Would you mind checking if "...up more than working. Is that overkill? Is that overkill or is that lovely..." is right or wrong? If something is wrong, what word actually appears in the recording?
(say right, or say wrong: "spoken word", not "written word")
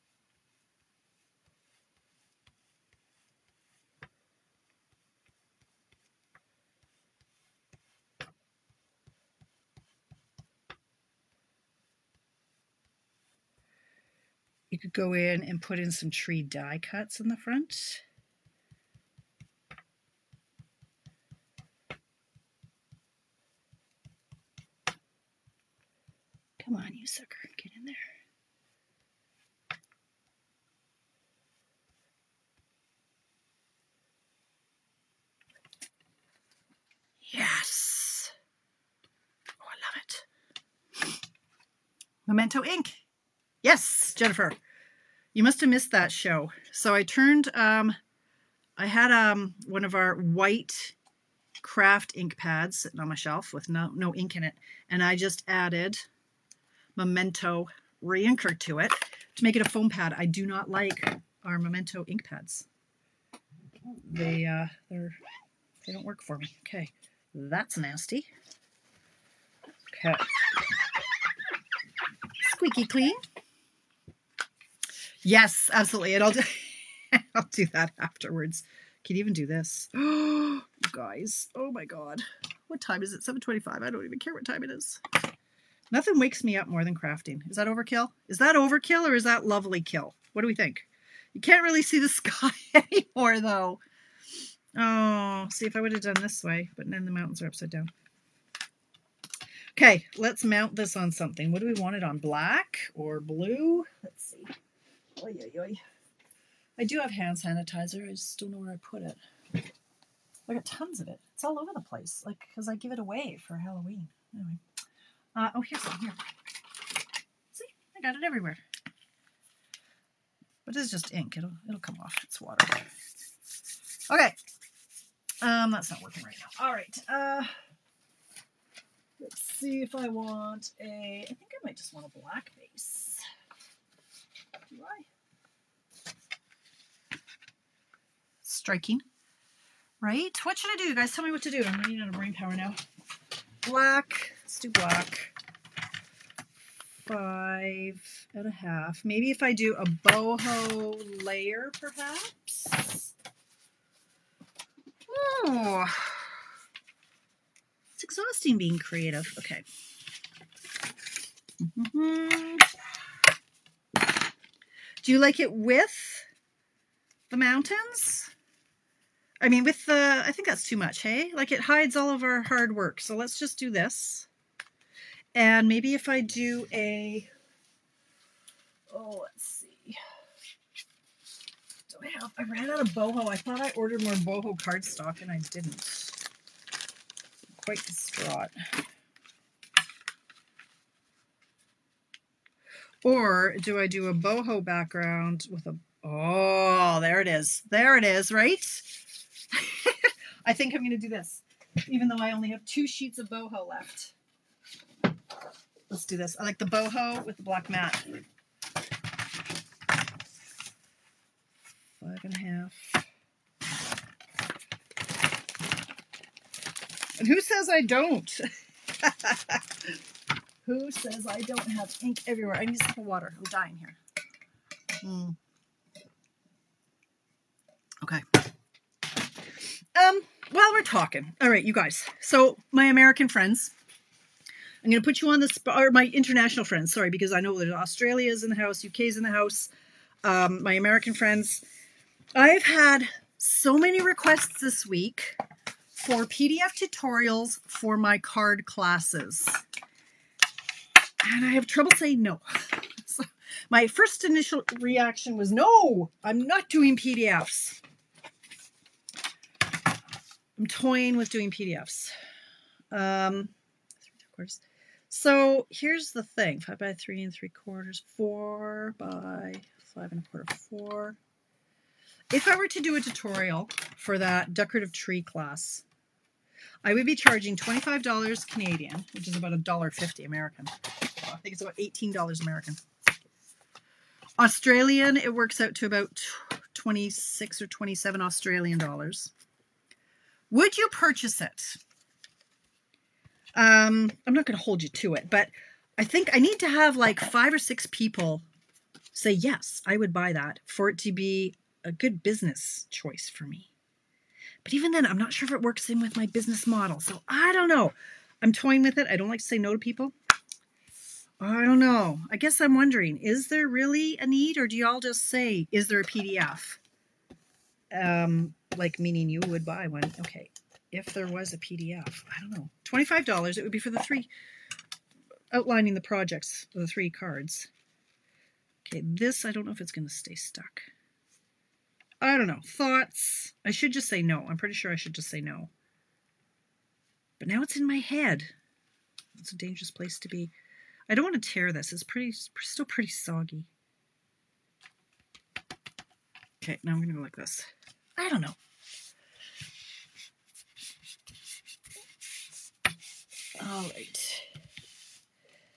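wrong: "crafting", not "working".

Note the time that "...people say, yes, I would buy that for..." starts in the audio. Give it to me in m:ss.
4:57.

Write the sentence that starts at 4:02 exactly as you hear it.
I've had so many requests this week for PDF tutorials for my card classes and I have trouble saying no.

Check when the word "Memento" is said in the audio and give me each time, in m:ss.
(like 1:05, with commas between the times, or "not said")
0:42, 0:56, 1:01.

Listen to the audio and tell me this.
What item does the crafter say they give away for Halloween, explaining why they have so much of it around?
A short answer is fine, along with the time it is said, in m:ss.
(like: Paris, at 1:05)
Hand sanitizer, at 1:47.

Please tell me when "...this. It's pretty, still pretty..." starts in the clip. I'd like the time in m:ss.
5:41.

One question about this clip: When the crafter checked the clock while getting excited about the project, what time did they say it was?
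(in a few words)
7:25.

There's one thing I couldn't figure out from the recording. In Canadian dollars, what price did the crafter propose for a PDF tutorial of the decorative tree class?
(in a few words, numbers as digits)
$25.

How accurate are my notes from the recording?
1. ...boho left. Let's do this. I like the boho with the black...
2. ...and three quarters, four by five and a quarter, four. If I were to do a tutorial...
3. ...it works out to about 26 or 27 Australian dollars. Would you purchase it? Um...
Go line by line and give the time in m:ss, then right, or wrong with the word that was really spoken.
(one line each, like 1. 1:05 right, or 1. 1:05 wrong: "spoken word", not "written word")
1. 3:23 right
2. 4:27 right
3. 4:45 right.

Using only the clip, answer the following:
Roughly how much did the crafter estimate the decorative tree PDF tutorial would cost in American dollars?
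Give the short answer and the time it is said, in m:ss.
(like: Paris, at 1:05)
$18, at 4:41.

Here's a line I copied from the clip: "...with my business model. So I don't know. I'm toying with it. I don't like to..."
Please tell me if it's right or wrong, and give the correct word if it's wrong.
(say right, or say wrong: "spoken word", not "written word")
right.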